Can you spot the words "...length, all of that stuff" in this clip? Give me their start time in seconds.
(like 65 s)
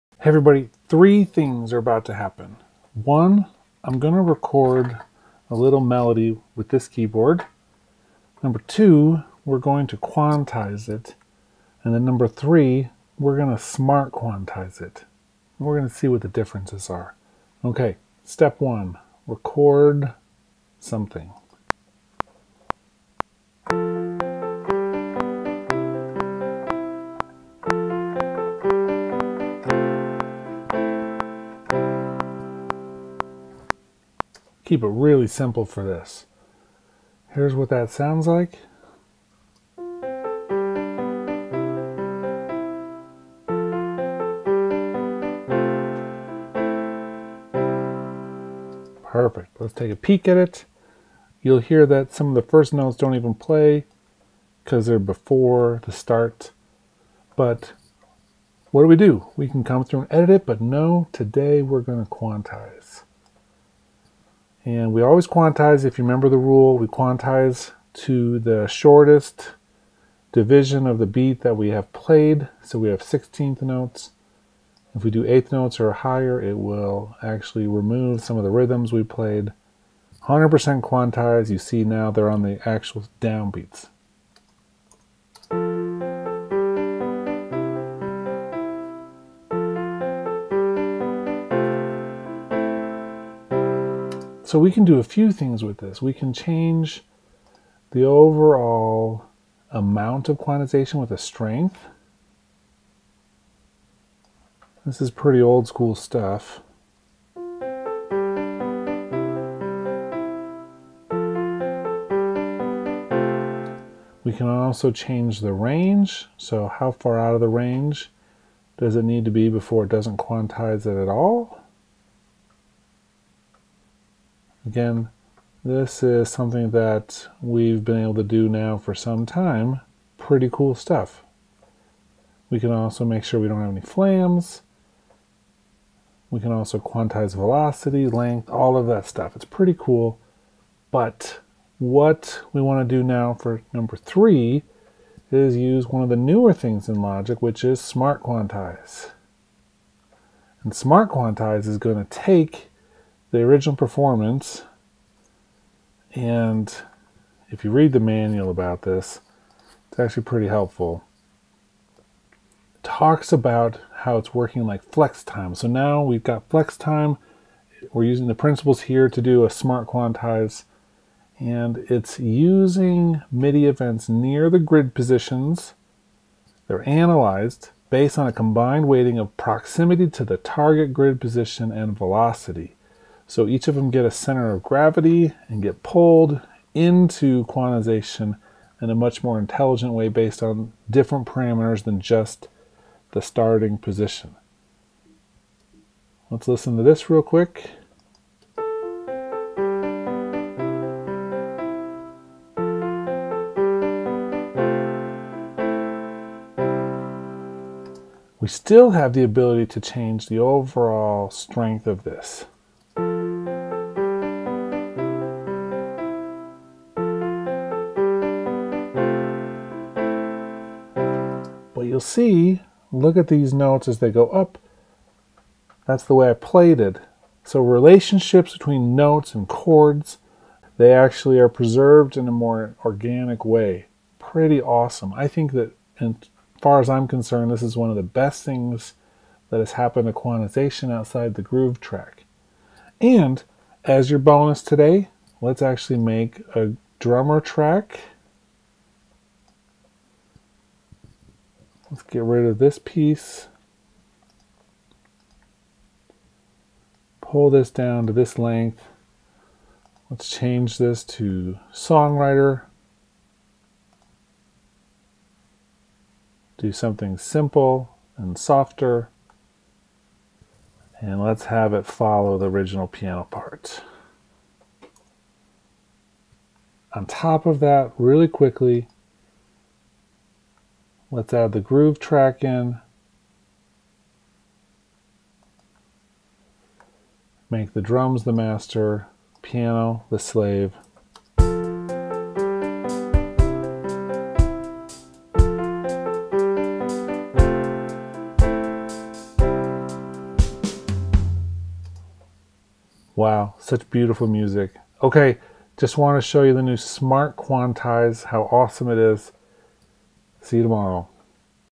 138 s.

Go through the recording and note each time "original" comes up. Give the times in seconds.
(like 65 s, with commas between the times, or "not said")
153 s, 272 s.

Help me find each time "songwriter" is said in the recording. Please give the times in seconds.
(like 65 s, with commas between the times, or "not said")
261 s.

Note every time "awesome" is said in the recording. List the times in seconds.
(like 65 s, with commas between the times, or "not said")
234 s, 308 s.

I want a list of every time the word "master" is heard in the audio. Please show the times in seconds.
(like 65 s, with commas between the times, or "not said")
288 s.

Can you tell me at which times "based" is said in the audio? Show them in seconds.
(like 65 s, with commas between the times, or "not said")
177 s, 190 s.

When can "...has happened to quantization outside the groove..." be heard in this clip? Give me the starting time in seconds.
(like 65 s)
239 s.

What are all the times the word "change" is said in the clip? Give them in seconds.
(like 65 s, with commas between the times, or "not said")
96 s, 114 s, 209 s, 260 s.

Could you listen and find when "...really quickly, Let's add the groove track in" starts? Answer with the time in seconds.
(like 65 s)
277 s.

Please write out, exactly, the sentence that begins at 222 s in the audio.
you'll see, look at these notes as they go up.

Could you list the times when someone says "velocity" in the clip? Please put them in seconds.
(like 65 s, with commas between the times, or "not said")
137 s, 181 s.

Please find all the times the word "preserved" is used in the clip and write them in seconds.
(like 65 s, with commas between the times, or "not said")
231 s.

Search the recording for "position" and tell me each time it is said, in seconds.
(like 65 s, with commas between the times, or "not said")
174 s, 181 s, 193 s.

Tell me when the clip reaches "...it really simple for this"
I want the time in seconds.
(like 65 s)
34 s.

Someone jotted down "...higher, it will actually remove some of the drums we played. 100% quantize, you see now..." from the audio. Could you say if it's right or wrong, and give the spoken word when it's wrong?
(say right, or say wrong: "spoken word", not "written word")
wrong: "rhythms", not "drums".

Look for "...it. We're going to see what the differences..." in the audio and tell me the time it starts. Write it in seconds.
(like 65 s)
14 s.